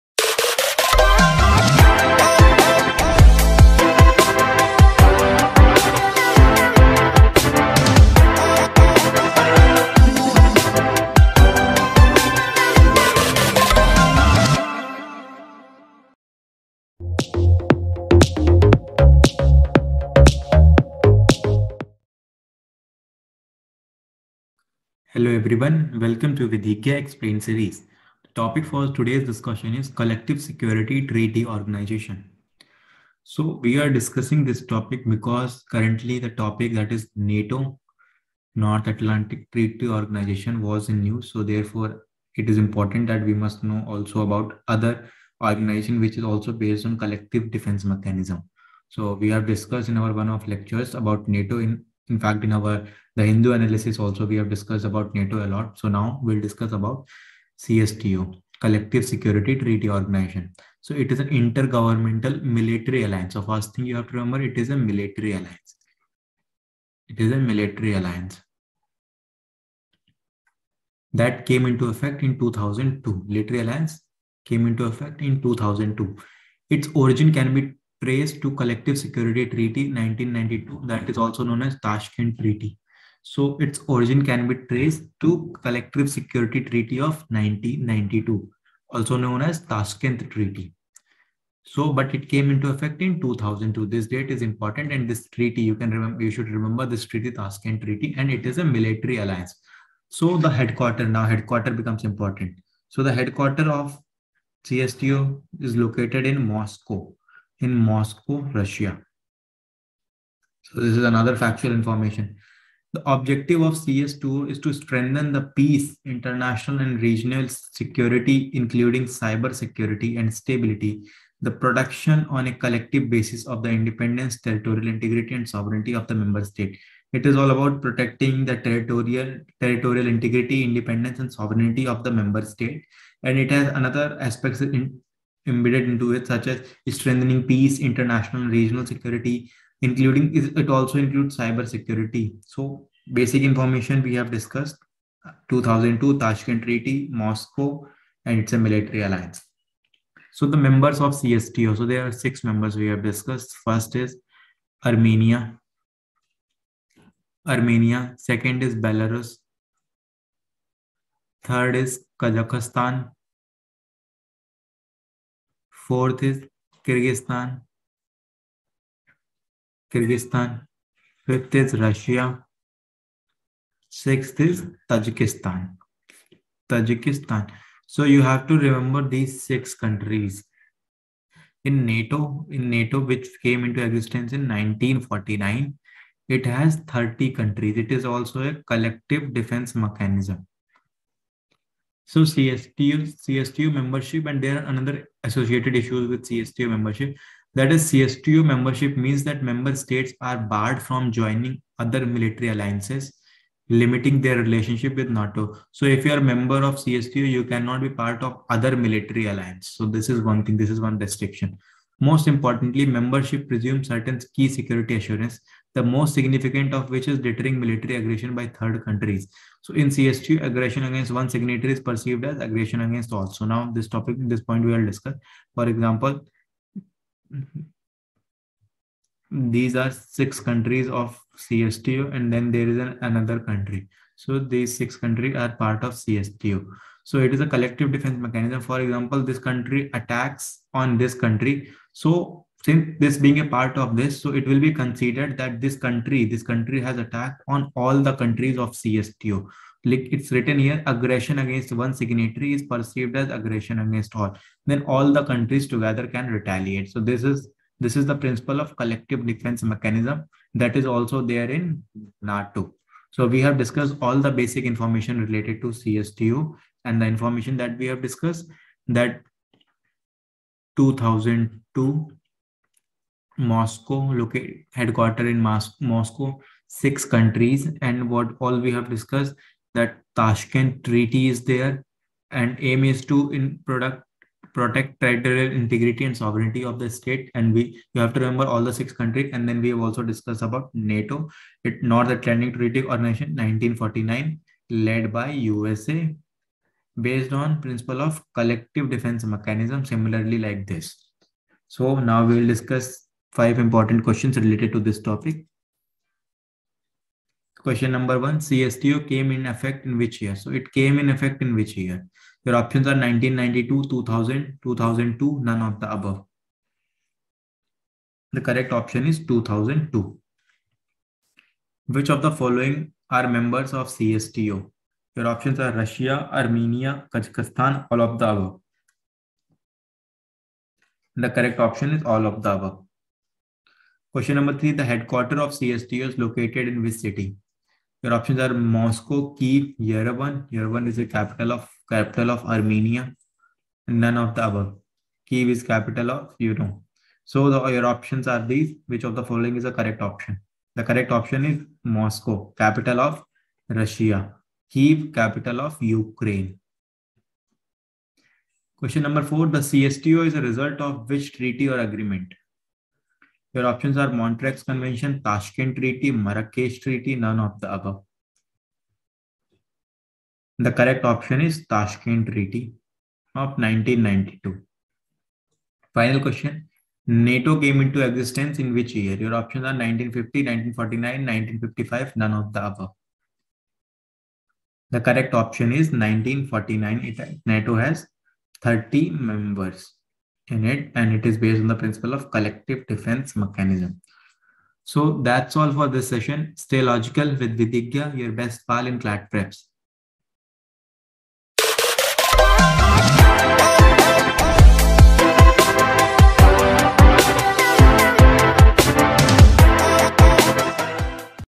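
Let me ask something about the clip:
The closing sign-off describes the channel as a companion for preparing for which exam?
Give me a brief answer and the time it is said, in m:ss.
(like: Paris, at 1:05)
CLAT, at 6:38.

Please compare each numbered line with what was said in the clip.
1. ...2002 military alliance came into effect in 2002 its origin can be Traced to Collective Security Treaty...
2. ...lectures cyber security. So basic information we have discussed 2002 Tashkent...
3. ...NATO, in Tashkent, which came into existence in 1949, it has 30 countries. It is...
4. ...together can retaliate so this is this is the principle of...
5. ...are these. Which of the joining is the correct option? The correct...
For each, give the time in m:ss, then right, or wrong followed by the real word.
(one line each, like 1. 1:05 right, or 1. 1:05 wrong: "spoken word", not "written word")
1. 1:12 right
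2. 2:20 wrong: "includes", not "lectures"
3. 3:01 wrong: "NATO", not "Tashkent"
4. 4:15 right
5. 5:48 wrong: "following", not "joining".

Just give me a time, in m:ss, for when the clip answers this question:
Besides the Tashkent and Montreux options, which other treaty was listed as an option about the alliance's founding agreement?
6:06.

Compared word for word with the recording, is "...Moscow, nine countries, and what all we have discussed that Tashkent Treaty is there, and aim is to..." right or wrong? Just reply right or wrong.
wrong.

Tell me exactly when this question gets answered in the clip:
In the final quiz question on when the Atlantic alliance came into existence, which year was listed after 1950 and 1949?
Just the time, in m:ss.
6:21.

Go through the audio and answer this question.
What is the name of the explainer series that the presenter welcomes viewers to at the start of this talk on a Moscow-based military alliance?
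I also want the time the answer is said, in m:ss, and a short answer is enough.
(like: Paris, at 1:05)
Vidhigya Explain, at 0:26.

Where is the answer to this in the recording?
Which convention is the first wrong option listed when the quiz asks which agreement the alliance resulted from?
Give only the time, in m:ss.
6:04.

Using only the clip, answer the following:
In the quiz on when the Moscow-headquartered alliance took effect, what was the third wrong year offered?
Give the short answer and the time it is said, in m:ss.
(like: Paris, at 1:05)
2000, at 5:13.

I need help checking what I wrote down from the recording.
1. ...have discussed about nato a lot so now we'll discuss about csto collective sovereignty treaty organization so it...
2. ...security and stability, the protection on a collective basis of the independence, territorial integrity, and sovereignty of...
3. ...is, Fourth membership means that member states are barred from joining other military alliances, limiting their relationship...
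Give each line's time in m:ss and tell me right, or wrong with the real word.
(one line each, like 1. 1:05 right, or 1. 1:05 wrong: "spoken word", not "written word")
1. 0:54 wrong: "security", not "sovereignty"
2. 1:59 right
3. 3:17 wrong: "CSTO", not "Fourth".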